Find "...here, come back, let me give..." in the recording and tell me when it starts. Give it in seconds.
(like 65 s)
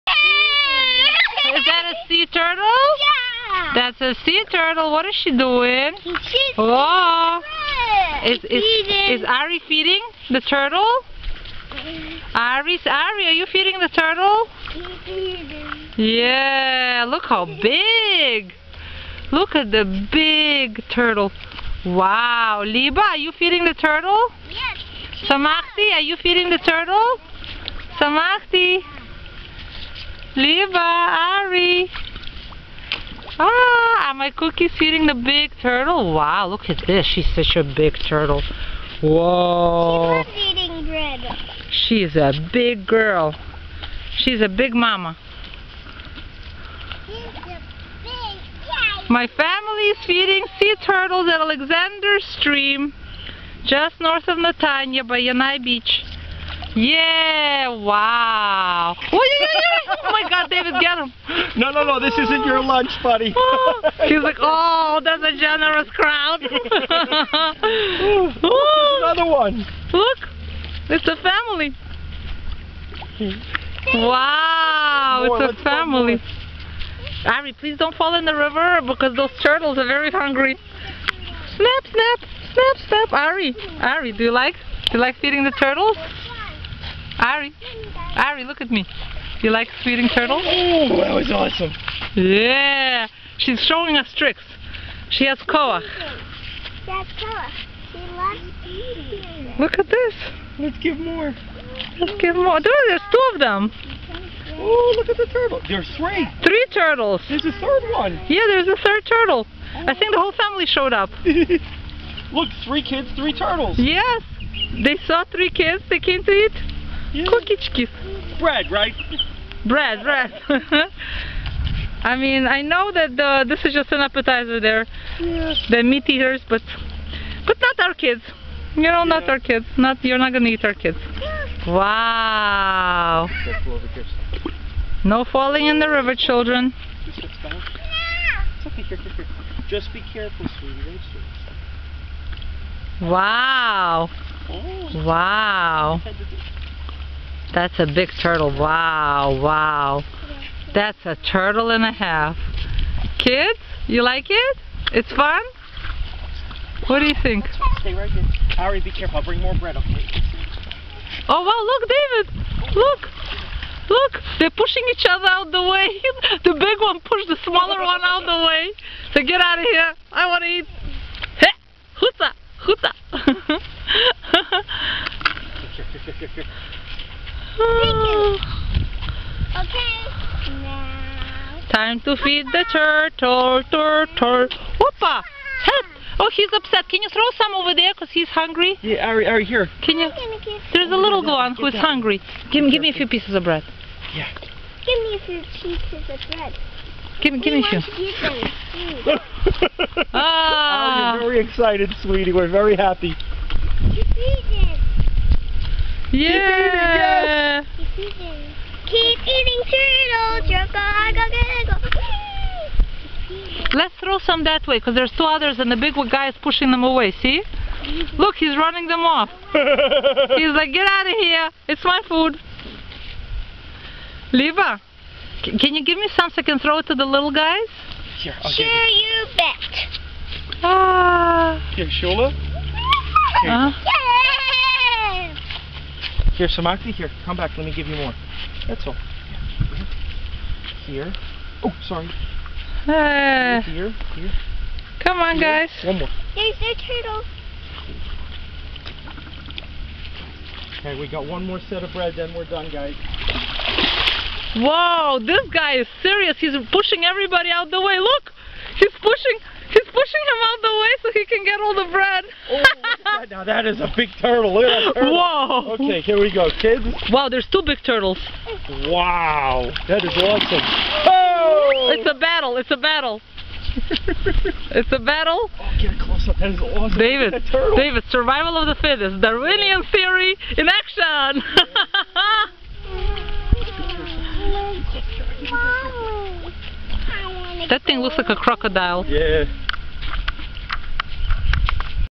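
236 s.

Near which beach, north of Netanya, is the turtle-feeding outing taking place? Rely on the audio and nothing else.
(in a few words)
Yanai Beach.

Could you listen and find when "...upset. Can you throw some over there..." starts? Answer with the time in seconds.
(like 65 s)
186 s.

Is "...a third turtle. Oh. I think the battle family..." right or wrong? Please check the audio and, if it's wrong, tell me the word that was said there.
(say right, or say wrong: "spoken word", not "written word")
wrong: "whole", not "battle".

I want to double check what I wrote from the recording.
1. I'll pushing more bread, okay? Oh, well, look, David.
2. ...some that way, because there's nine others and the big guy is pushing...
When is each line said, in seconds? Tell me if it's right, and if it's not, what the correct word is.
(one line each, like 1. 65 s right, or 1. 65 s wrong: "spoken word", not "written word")
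1. 159 s wrong: "bring", not "pushing"
2. 214 s wrong: "two", not "nine".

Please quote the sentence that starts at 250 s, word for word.
Okay, we got one more set of bread, then we're done, guys.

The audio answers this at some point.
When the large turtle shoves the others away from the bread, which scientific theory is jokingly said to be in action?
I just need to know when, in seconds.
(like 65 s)
279 s.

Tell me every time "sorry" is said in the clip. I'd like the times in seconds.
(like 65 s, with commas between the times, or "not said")
241 s.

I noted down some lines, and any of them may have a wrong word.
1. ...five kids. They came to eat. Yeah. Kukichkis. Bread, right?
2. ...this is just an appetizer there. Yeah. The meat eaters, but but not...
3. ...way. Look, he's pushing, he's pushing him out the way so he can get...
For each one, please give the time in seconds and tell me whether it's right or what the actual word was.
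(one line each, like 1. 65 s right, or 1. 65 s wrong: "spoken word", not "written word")
1. 115 s wrong: "three", not "five"
2. 123 s right
3. 257 s right.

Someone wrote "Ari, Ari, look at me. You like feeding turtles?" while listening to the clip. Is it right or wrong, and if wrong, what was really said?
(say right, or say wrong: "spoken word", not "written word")
right.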